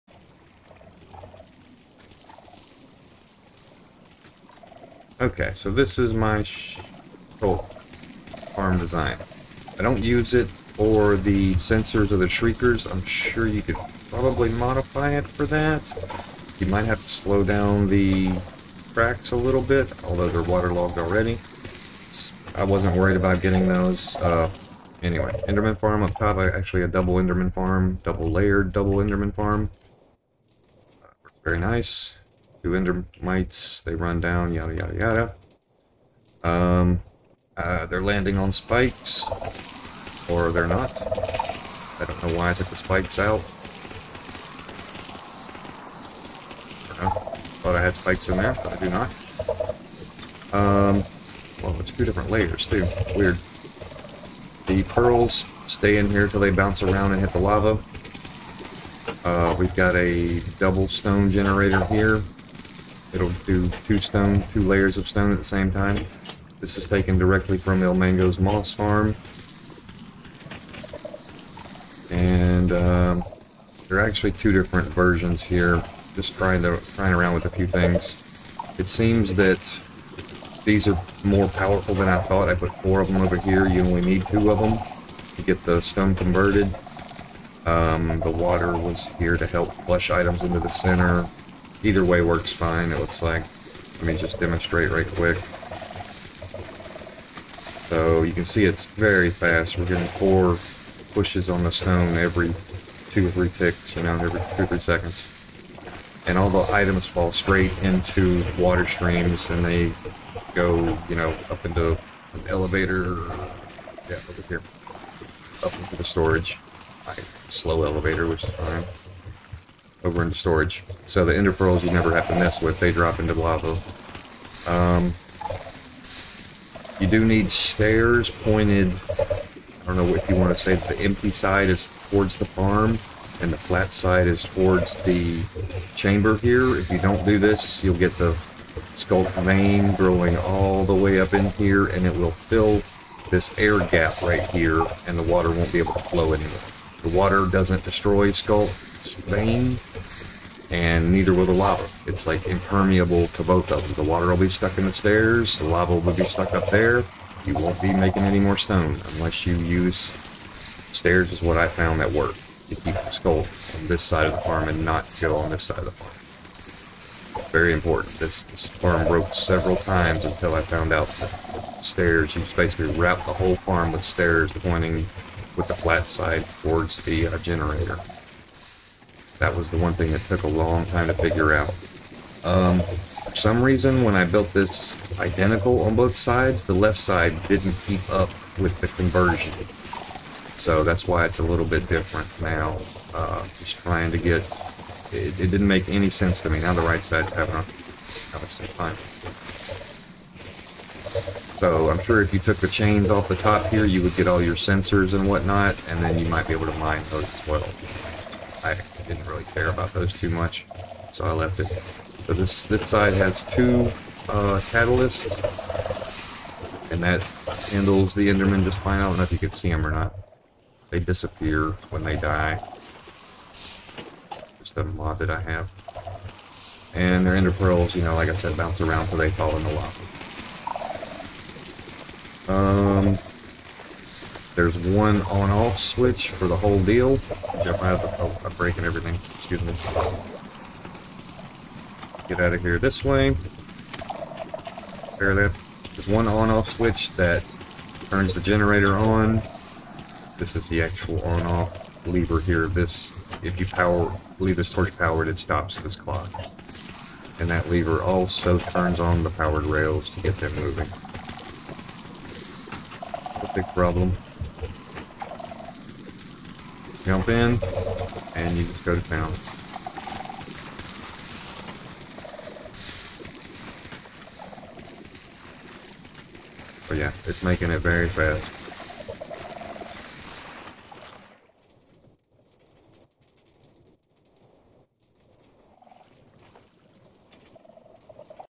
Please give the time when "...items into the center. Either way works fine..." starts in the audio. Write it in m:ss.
1:30.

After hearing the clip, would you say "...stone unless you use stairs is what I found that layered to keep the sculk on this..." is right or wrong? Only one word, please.
wrong.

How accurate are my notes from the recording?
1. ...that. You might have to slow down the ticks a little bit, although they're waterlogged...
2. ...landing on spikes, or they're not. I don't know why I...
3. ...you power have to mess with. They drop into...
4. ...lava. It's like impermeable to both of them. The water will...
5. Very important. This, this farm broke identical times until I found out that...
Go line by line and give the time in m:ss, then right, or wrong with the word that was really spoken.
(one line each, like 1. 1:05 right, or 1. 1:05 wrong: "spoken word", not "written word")
1. 0:15 wrong: "cracks", not "ticks"
2. 0:38 right
3. 2:01 wrong: "never", not "power"
4. 2:31 right
5. 2:47 wrong: "several", not "identical".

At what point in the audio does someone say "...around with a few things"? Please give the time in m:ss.
1:17.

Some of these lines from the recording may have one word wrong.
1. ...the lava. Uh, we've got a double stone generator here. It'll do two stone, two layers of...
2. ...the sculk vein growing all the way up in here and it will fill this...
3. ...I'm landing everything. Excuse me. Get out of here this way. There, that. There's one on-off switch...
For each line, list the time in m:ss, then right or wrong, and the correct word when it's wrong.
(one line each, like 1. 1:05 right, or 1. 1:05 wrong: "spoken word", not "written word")
1. 0:57 right
2. 2:18 right
3. 3:58 wrong: "breaking", not "landing".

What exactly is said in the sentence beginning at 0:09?
I don't use it for the sensors or the shriekers.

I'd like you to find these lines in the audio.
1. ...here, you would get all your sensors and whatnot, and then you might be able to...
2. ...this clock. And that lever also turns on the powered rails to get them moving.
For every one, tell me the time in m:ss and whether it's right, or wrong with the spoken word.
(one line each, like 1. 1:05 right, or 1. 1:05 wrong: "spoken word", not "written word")
1. 3:23 right
2. 4:15 right.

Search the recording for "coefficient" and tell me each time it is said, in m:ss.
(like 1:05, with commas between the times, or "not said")
not said.